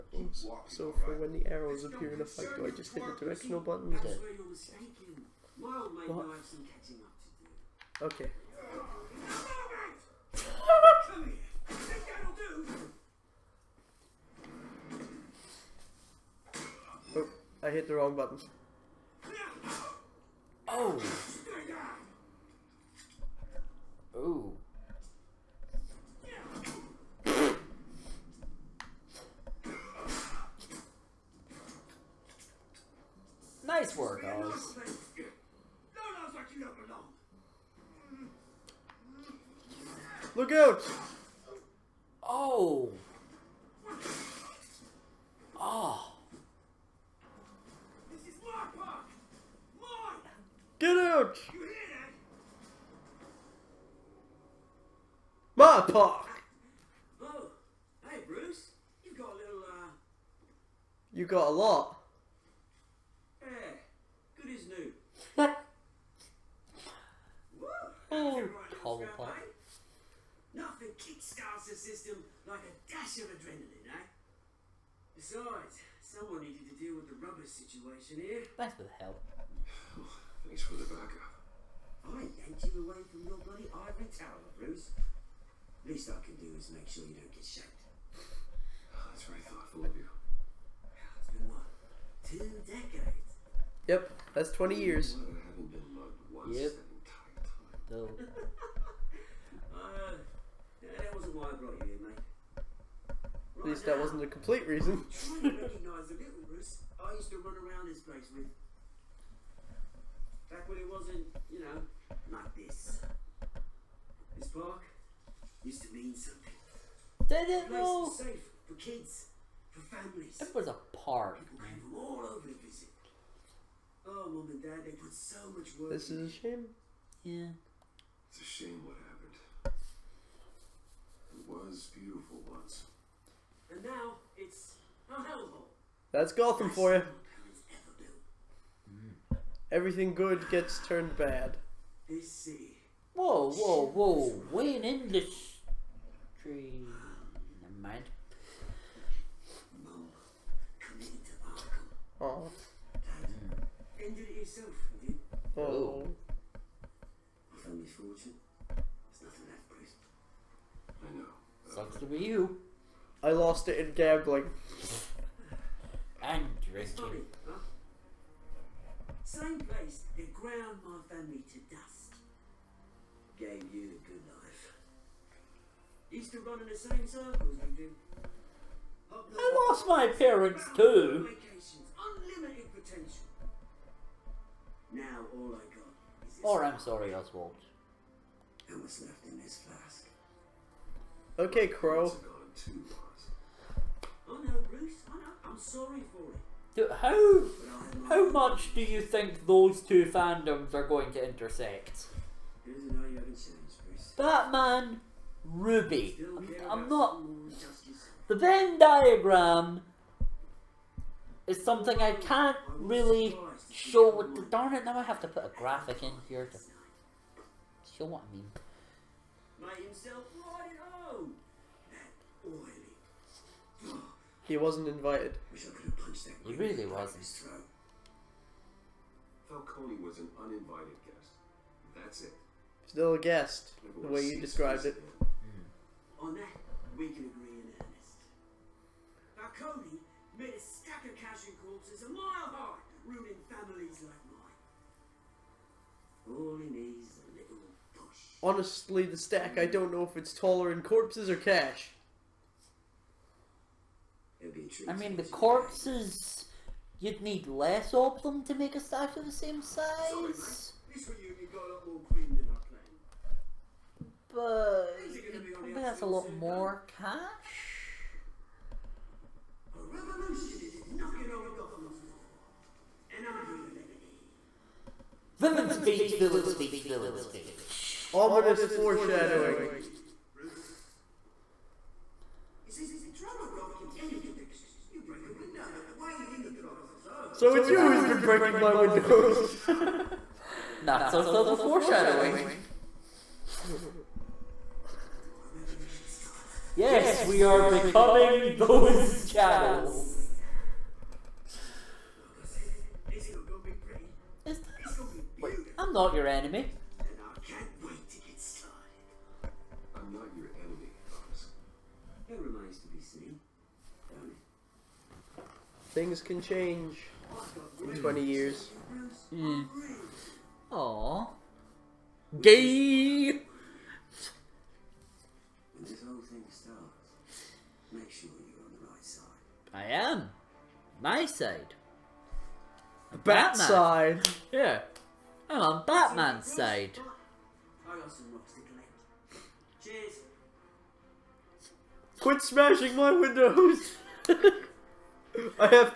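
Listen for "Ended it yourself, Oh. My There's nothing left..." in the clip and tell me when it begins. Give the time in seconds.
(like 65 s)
153 s.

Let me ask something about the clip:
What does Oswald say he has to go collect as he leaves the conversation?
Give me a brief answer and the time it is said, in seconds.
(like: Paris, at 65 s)
Rocks, at 338 s.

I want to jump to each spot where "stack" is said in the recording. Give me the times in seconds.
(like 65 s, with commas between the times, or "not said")
240 s, 249 s.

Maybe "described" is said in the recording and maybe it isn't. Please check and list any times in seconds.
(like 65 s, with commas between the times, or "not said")
234 s.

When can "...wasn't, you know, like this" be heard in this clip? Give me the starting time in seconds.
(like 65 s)
110 s.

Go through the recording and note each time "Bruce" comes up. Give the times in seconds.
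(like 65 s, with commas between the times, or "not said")
58 s, 84 s, 194 s.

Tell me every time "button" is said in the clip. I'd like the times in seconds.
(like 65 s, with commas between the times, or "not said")
3 s, 18 s.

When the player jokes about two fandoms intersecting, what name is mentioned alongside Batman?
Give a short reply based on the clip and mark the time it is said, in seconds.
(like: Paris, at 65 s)
Ruby, at 205 s.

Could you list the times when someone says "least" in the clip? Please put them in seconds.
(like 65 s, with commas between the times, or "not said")
85 s, 103 s.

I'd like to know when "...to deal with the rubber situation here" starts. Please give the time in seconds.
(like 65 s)
76 s.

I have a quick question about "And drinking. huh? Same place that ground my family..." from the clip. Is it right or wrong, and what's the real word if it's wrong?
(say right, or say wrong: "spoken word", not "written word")
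right.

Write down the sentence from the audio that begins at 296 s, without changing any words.
Yes, we are becoming those channels.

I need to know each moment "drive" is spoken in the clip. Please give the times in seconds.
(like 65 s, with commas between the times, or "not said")
not said.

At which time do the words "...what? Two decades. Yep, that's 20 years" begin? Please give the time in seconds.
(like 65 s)
91 s.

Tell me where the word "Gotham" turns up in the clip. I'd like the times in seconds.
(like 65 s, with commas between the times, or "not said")
136 s, 271 s.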